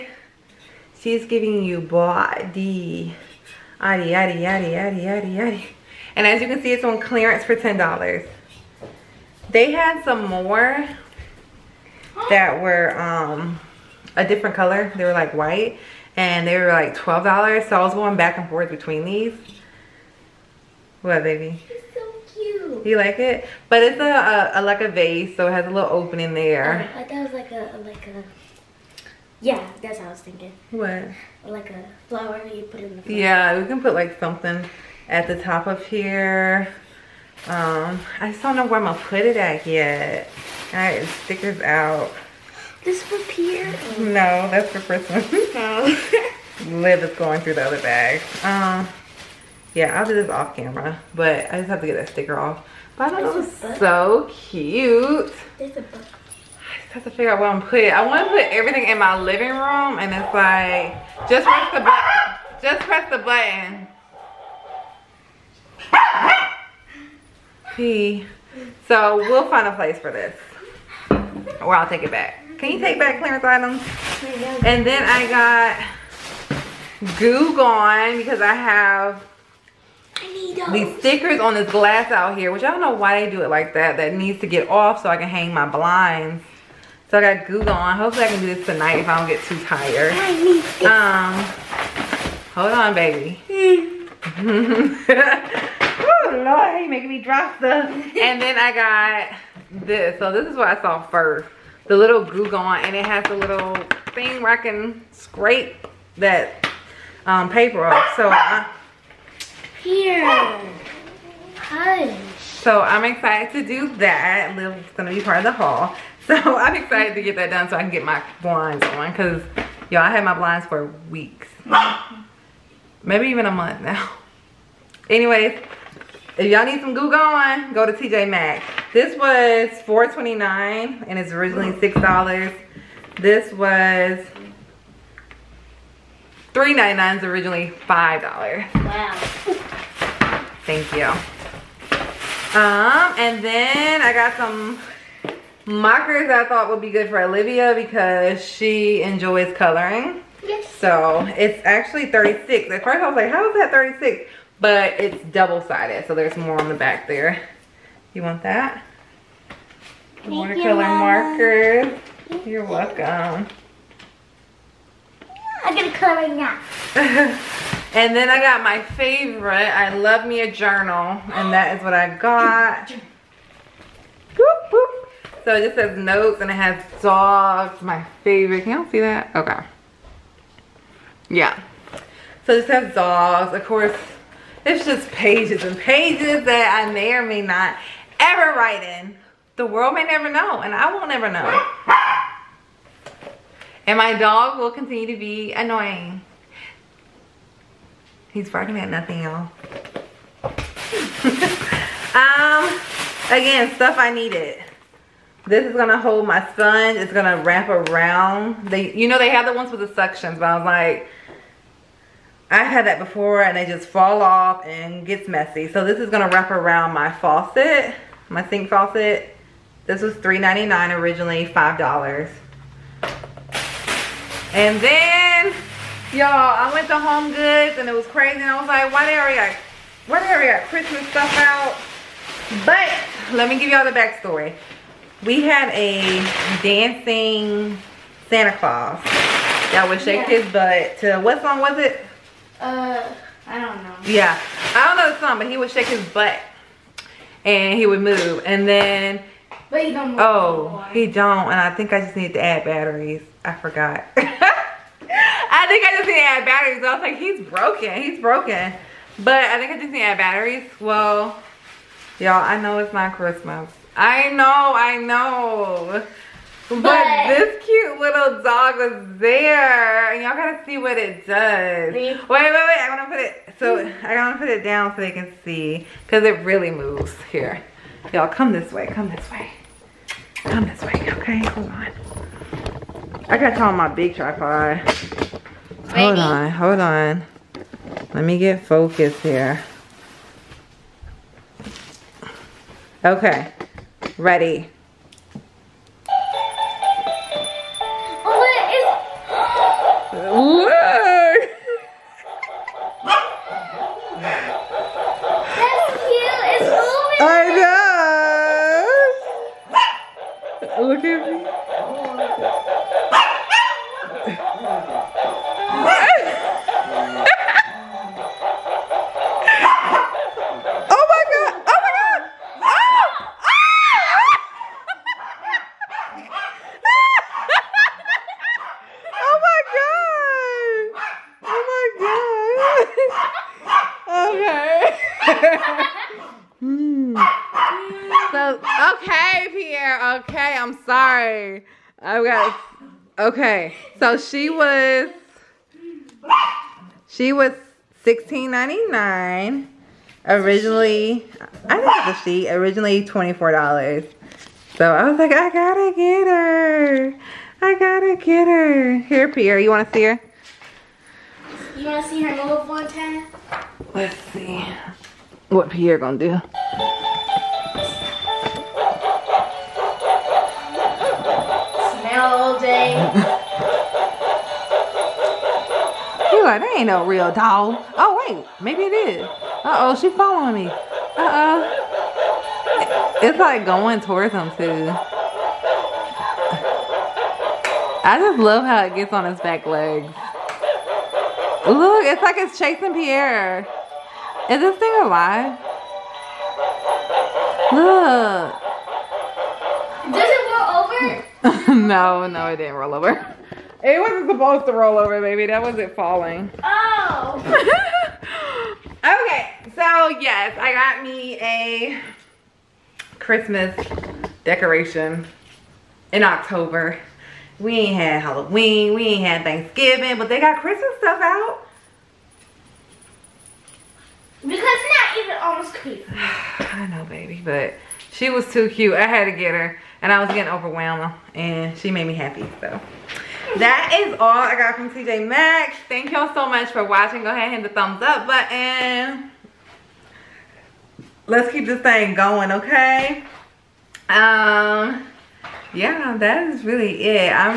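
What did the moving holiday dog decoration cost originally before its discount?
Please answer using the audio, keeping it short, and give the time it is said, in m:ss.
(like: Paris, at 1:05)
$24, at 5:53.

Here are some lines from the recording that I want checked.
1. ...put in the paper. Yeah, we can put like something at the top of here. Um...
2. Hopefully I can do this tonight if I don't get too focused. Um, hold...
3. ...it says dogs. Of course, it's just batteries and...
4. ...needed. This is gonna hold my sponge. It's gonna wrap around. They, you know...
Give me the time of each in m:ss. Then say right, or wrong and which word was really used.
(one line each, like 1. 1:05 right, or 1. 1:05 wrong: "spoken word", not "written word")
1. 0:32 wrong: "flower", not "paper"
2. 1:27 wrong: "tired", not "focused"
3. 3:02 wrong: "pages", not "batteries"
4. 3:24 right.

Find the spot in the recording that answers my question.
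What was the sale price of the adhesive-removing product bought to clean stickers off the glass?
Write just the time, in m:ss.
2:09.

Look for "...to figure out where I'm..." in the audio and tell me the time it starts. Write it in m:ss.
0:57.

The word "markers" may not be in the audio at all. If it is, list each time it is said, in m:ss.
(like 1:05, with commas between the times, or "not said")
2:25, 2:40.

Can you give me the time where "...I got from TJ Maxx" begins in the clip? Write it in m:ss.
7:14.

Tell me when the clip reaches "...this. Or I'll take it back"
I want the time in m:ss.
1:10.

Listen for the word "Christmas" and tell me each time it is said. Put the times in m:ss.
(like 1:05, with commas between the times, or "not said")
0:44, 3:50, 4:23, 6:53, 7:00, 7:05.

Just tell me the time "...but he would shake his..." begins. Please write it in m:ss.
4:05.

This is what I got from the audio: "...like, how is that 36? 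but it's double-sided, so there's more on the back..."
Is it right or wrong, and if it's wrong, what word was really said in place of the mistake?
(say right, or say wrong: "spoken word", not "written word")
right.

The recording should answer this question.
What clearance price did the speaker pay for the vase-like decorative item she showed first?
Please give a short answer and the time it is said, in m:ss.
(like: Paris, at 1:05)
$10, at 0:07.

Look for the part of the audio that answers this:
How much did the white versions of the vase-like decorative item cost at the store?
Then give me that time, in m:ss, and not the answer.
0:16.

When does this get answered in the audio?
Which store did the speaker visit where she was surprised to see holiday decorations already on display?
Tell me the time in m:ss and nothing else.
3:46.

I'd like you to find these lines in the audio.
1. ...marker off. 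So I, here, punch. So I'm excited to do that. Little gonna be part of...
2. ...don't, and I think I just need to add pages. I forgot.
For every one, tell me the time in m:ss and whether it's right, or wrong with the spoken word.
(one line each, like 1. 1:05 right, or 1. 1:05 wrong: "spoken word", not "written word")
1. 1:47 wrong: "paper", not "marker"
2. 4:11 wrong: "batteries", not "pages".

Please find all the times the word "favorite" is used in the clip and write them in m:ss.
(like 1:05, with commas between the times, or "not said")
2:48, 2:58.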